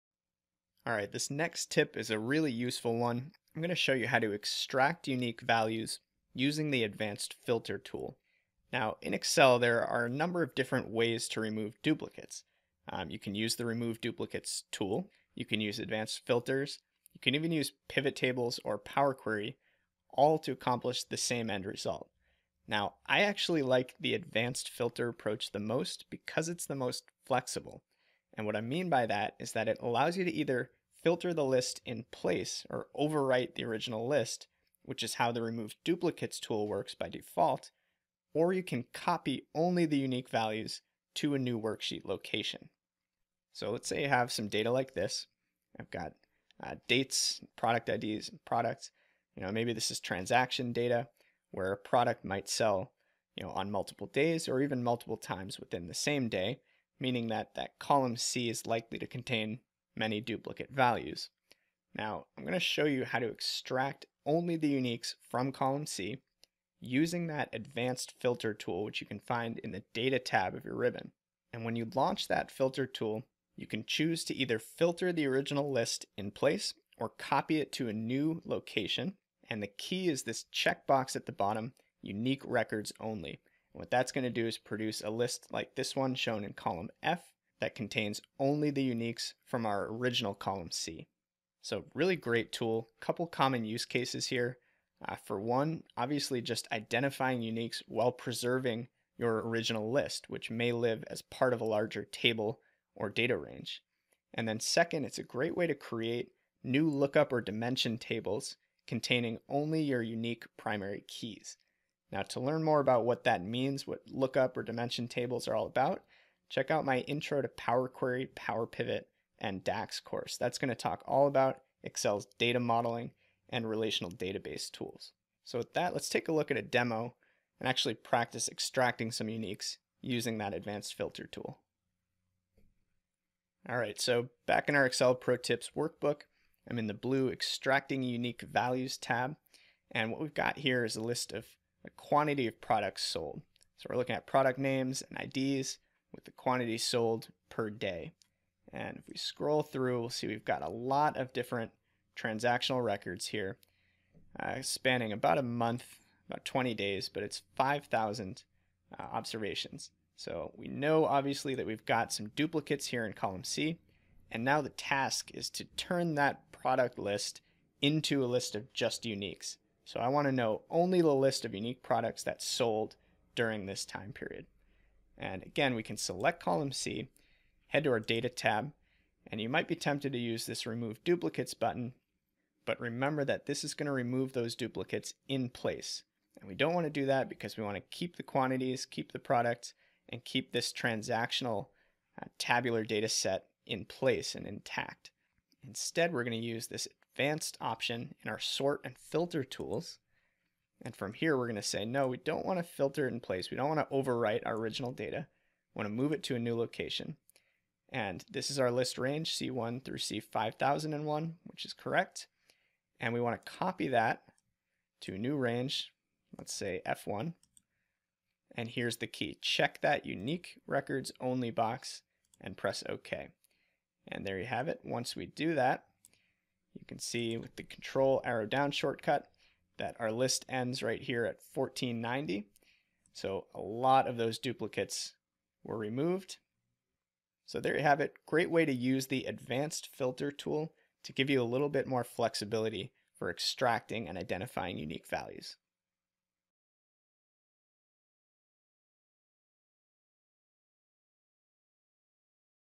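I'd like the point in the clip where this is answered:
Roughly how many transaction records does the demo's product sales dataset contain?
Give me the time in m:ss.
2:37.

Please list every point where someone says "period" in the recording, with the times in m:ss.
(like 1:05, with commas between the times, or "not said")
2:54.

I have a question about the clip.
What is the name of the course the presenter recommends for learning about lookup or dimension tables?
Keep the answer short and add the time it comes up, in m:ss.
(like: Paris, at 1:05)
Intro to Power Query, Power Pivot, and DAX, at 1:56.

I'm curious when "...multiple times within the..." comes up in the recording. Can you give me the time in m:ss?
0:54.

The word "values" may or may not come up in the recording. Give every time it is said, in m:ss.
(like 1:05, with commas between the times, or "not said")
0:05, 0:40, 1:00, 2:18, 4:05.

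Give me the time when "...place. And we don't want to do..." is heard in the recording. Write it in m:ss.
3:05.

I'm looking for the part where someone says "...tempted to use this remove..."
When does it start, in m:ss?
2:59.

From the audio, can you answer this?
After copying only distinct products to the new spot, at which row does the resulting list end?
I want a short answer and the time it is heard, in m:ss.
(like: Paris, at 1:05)
1490, at 3:51.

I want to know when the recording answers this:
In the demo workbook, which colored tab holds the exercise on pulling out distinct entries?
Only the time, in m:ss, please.
2:16.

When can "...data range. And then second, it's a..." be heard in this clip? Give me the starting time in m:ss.
1:43.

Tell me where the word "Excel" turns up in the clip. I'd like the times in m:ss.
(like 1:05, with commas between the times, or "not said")
0:09, 2:01, 2:14.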